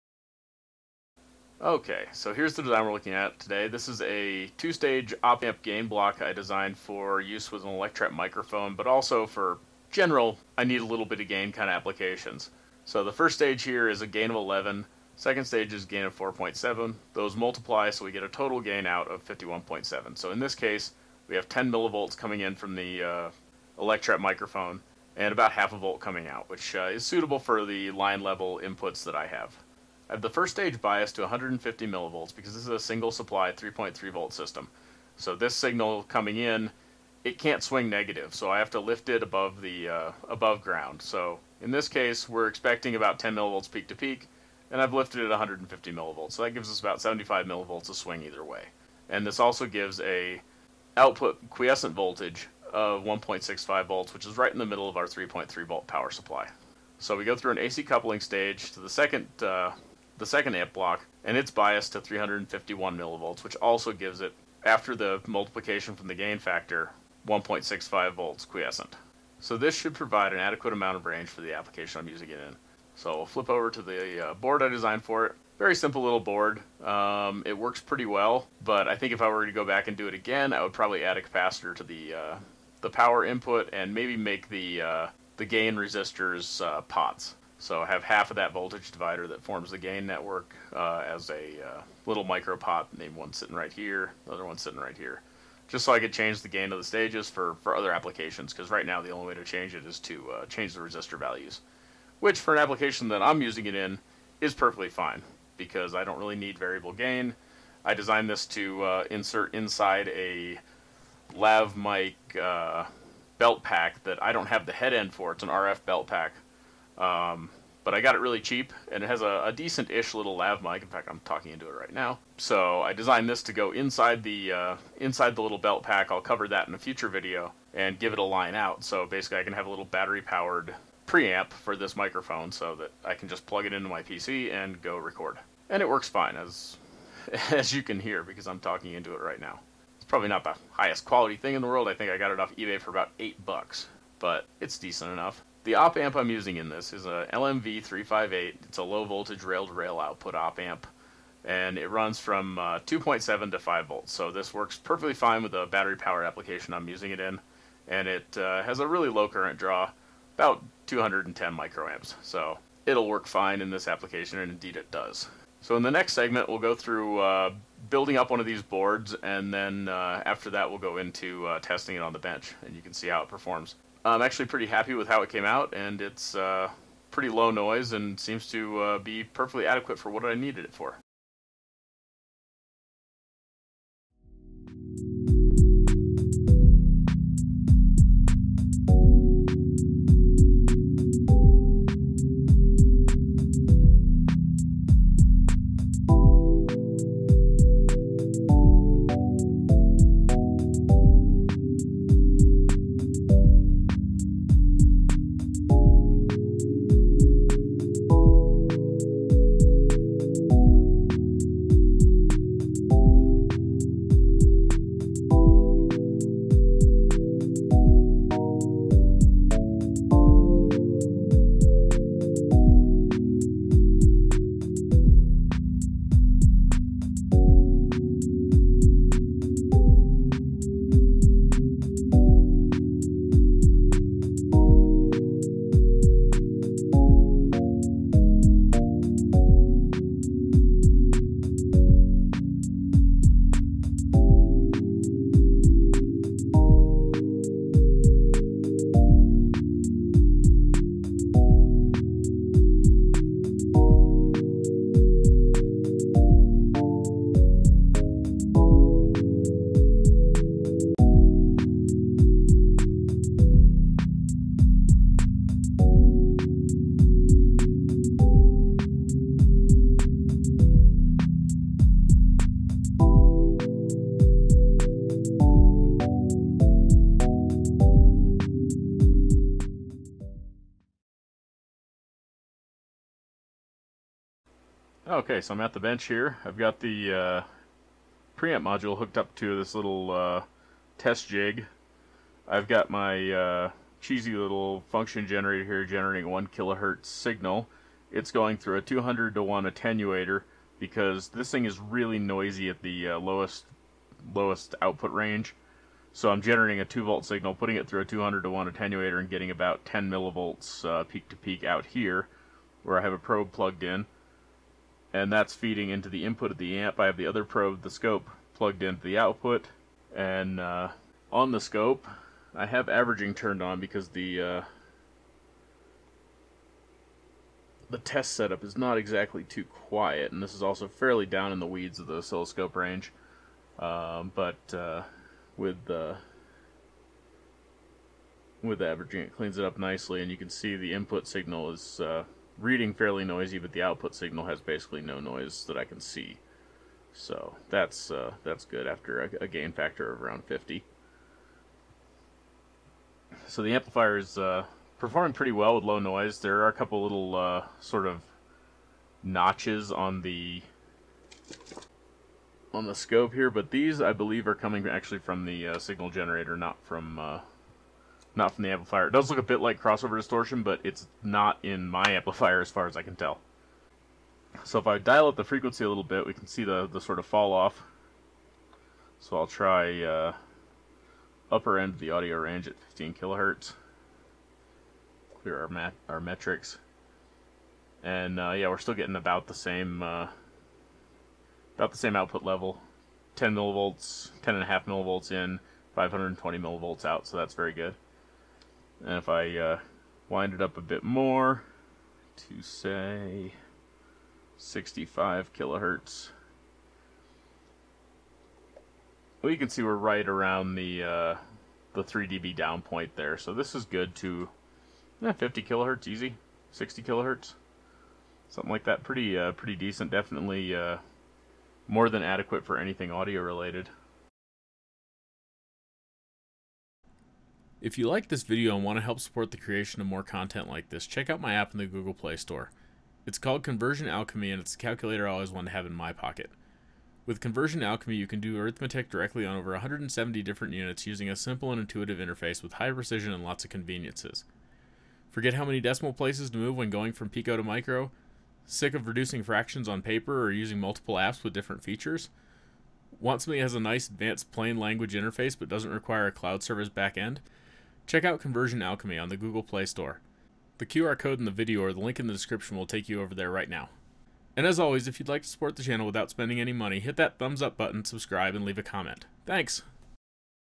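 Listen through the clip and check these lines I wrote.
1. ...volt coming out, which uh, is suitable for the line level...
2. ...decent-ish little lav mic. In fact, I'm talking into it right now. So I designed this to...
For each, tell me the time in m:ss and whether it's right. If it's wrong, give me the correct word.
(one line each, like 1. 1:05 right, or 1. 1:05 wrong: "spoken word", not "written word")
1. 0:25 right
2. 1:59 right.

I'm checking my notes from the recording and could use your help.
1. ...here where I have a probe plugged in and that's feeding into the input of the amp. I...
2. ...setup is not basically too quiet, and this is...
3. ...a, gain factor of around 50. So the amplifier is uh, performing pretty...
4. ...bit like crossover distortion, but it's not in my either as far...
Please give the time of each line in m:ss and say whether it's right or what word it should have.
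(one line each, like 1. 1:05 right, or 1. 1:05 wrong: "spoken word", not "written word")
1. 5:11 right
2. 5:28 wrong: "exactly", not "basically"
3. 5:49 right
4. 6:09 wrong: "amplifier", not "either".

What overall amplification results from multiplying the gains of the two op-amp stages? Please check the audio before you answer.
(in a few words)
51.7.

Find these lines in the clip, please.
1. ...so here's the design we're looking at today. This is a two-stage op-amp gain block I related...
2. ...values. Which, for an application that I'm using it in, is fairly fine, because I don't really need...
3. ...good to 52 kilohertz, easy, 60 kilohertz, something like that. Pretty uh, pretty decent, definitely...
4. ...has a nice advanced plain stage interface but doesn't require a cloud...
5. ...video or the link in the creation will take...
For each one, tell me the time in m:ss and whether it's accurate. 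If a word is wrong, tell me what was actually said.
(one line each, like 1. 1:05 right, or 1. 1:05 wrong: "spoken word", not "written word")
1. 0:02 wrong: "designed", not "related"
2. 1:41 wrong: "perfectly", not "fairly"
3. 6:53 wrong: "50", not "52"
4. 7:33 wrong: "language", not "stage"
5. 7:41 wrong: "description", not "creation".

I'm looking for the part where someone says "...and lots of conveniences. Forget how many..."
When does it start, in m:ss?
7:23.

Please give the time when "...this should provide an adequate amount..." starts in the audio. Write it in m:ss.
1:09.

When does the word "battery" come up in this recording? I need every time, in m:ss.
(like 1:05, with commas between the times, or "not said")
2:09, 2:35.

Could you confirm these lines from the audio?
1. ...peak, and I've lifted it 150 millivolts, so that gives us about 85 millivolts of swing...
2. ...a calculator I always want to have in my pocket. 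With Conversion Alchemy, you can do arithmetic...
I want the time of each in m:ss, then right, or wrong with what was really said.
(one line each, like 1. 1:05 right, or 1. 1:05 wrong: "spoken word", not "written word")
1. 0:43 wrong: "75", not "85"
2. 7:14 right.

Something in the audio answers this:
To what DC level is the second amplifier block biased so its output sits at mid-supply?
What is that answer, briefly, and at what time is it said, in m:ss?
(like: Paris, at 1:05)
351 millivolts, at 1:01.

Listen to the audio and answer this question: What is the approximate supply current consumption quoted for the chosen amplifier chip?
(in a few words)
210 microamps.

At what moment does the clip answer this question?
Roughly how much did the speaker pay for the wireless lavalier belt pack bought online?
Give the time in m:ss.
2:22.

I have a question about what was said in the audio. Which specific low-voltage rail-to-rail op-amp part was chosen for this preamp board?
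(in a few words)
LMV358.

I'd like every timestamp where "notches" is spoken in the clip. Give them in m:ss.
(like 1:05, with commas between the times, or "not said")
5:59.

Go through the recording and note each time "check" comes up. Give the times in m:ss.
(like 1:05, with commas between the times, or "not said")
7:11, 7:38.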